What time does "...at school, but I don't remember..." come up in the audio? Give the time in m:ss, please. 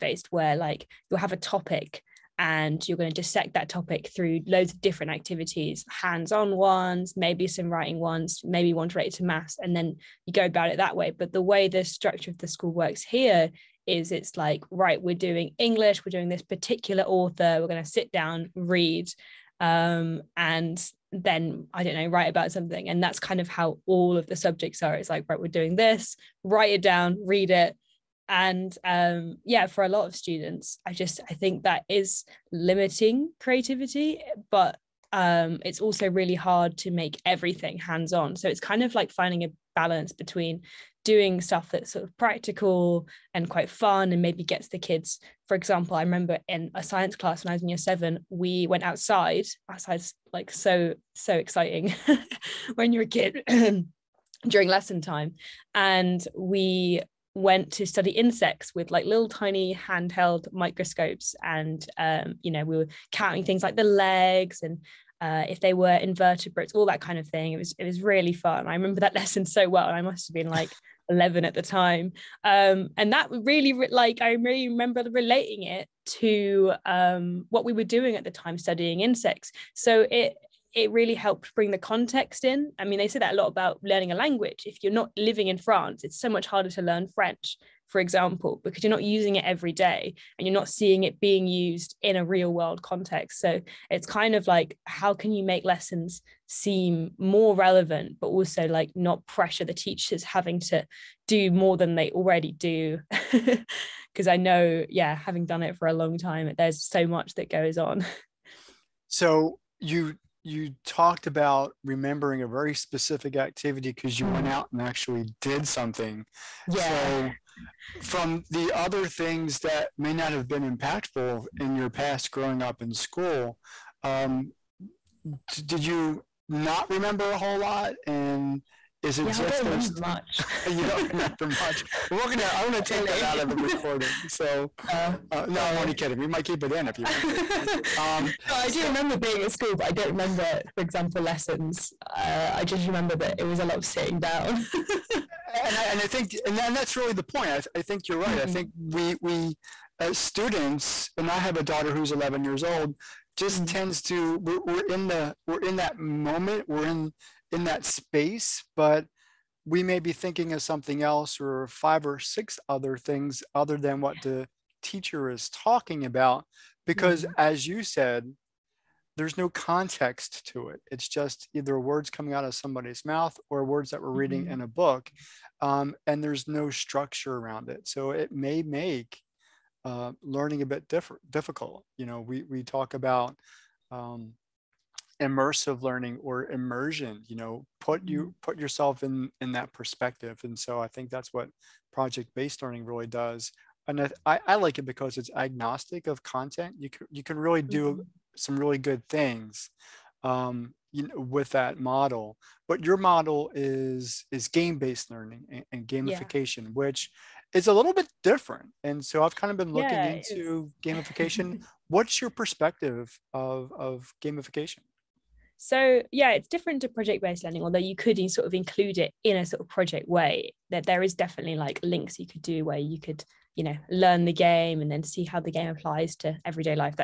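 2:19.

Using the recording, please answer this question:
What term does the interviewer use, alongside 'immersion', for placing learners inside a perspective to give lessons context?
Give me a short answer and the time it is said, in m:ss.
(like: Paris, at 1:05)
Immersive learning, at 3:05.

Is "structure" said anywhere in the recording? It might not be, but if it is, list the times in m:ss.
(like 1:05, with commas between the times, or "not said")
0:11, 2:56.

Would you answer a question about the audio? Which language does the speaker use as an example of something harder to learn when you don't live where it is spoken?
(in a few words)
French.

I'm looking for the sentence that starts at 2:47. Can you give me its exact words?
as you said there's no context to it.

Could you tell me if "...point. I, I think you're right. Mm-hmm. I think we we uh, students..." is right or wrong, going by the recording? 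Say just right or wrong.
right.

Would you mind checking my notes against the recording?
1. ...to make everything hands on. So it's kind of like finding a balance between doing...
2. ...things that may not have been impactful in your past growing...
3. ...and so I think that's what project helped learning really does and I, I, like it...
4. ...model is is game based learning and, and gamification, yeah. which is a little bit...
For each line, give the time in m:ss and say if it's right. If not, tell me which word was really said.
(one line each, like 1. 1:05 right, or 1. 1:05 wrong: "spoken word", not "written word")
1. 0:36 right
2. 1:59 right
3. 3:10 wrong: "based", not "helped"
4. 3:22 right.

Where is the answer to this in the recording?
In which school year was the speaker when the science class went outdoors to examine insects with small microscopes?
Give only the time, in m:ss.
0:47.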